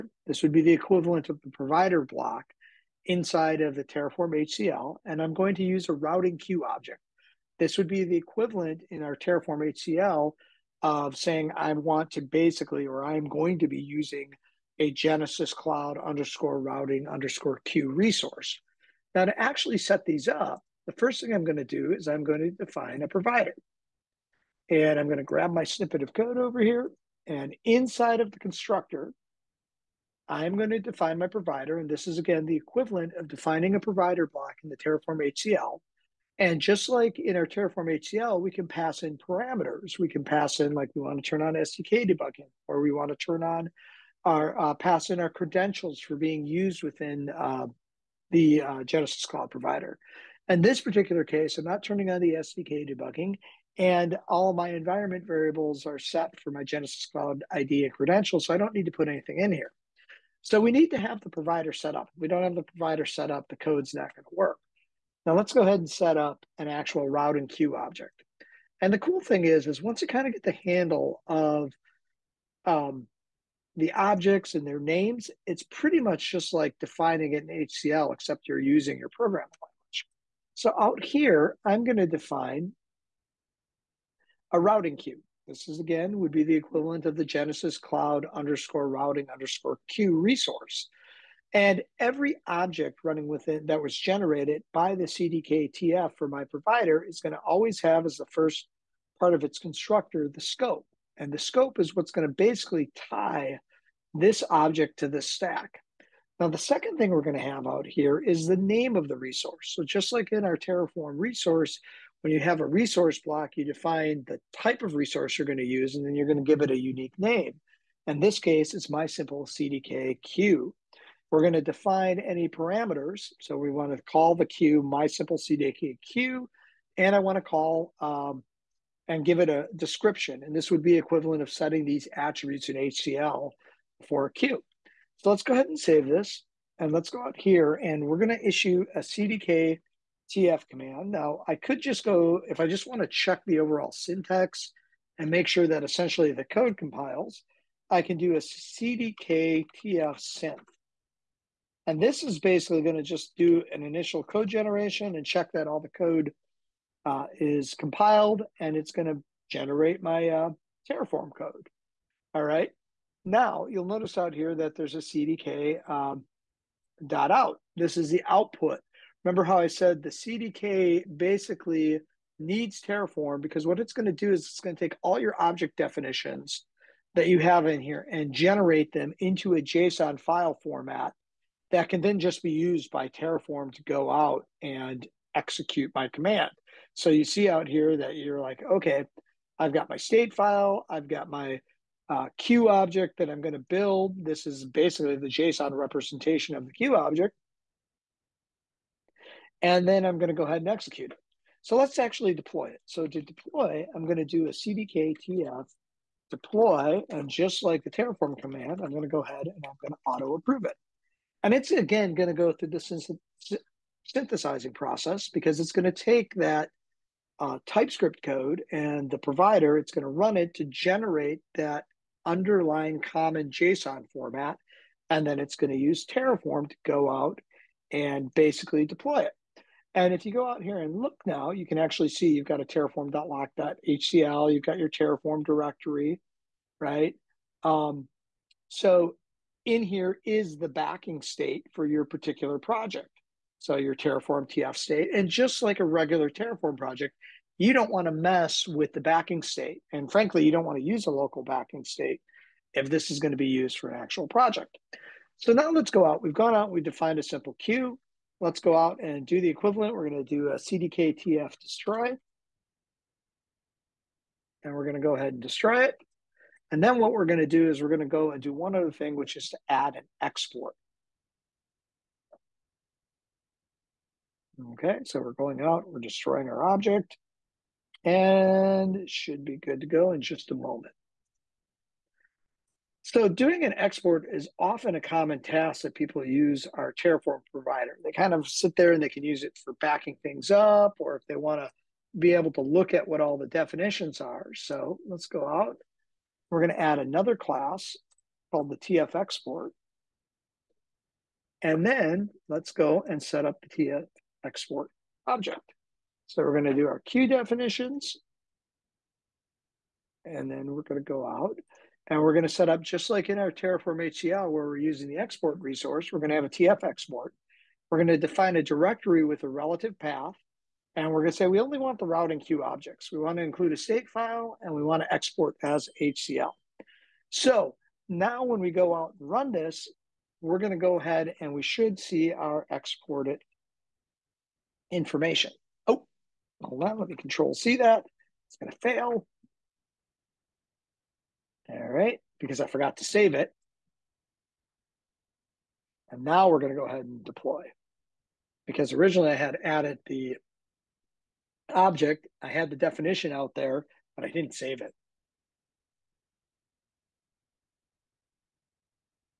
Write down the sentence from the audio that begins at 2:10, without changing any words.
And this would be equivalent of setting these attributes in HCL for a queue.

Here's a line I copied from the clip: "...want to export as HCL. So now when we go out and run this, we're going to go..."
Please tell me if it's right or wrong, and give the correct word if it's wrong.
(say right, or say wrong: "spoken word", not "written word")
right.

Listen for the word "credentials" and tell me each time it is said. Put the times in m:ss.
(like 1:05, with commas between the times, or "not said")
0:45, 0:57.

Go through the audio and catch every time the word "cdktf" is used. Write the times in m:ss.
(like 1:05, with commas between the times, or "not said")
3:24.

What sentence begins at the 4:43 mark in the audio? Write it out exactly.
So doing an export is often a common task that people use our Terraform provider.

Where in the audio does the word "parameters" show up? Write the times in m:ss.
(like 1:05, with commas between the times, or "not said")
0:39, 2:02.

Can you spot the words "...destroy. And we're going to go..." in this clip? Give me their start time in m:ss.
4:21.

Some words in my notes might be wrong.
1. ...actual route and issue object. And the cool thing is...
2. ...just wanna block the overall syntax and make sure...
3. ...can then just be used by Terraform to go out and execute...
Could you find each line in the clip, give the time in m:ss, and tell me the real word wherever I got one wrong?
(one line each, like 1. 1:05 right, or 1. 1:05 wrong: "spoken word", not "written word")
1. 1:06 wrong: "queue", not "issue"
2. 2:22 wrong: "check", not "block"
3. 3:01 right.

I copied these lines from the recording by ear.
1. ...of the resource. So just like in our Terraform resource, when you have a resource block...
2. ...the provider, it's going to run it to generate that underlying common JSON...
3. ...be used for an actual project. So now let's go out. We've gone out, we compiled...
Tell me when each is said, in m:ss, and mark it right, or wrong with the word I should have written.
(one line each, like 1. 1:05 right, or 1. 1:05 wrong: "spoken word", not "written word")
1. 1:48 right
2. 3:39 right
3. 4:13 wrong: "defined", not "compiled".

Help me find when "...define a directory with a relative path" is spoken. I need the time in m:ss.
5:18.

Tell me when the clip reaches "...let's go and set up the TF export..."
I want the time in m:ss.
5:02.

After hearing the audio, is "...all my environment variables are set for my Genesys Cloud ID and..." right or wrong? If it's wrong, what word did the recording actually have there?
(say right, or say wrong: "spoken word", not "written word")
right.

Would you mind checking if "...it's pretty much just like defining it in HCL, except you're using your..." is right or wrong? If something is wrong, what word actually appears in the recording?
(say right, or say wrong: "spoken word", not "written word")
right.